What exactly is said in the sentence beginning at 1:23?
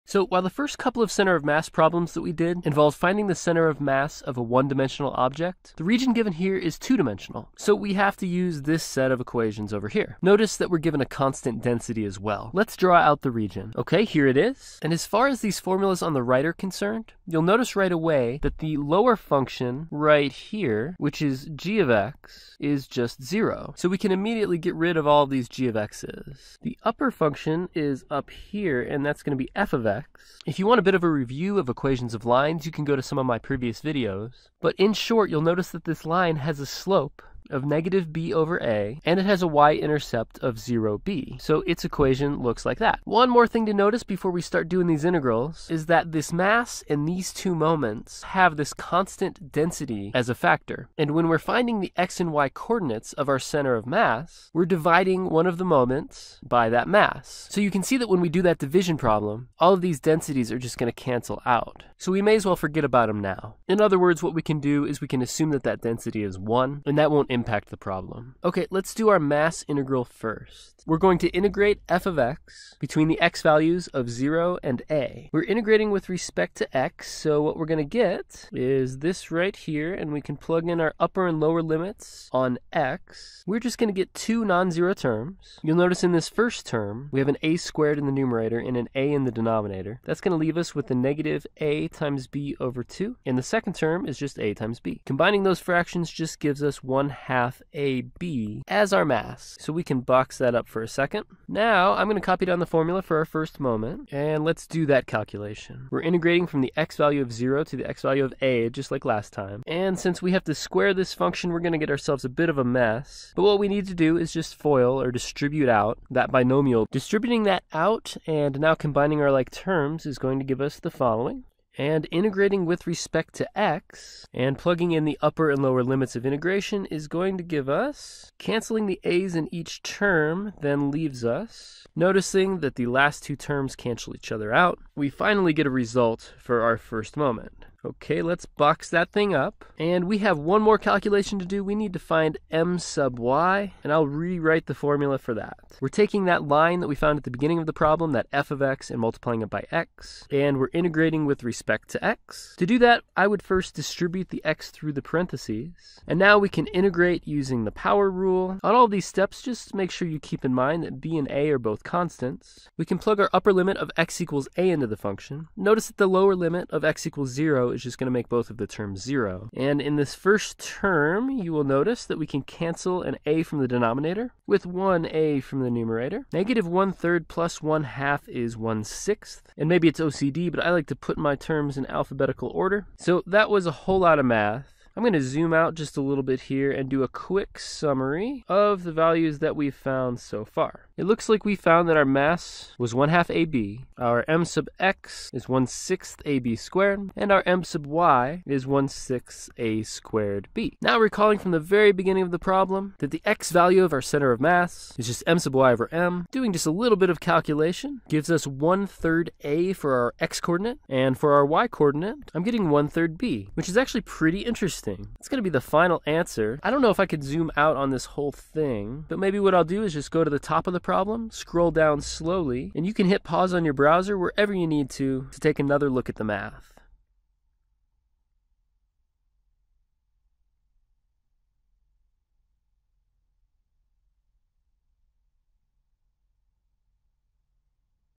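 We're just going to get two non-zero terms.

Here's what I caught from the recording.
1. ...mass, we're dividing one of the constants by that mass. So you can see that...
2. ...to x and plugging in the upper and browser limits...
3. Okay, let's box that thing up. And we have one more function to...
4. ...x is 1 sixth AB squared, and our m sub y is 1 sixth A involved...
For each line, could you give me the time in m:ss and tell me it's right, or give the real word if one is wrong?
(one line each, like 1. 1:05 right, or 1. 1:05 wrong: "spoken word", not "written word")
1. 0:53 wrong: "moments", not "constants"
2. 2:03 wrong: "lower", not "browser"
3. 2:17 wrong: "calculation", not "function"
4. 3:14 wrong: "squared", not "involved".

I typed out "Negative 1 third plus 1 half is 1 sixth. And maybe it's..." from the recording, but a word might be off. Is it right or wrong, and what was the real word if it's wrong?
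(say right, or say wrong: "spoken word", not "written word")
right.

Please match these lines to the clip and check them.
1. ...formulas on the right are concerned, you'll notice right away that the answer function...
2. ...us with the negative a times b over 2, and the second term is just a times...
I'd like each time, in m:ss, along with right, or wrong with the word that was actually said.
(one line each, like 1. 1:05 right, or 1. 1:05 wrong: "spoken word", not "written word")
1. 0:15 wrong: "lower", not "answer"
2. 1:30 right.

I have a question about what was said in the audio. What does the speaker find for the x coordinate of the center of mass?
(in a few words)
1/3 A.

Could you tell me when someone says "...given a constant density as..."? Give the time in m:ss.
0:10.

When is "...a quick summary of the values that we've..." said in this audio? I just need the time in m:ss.
3:07.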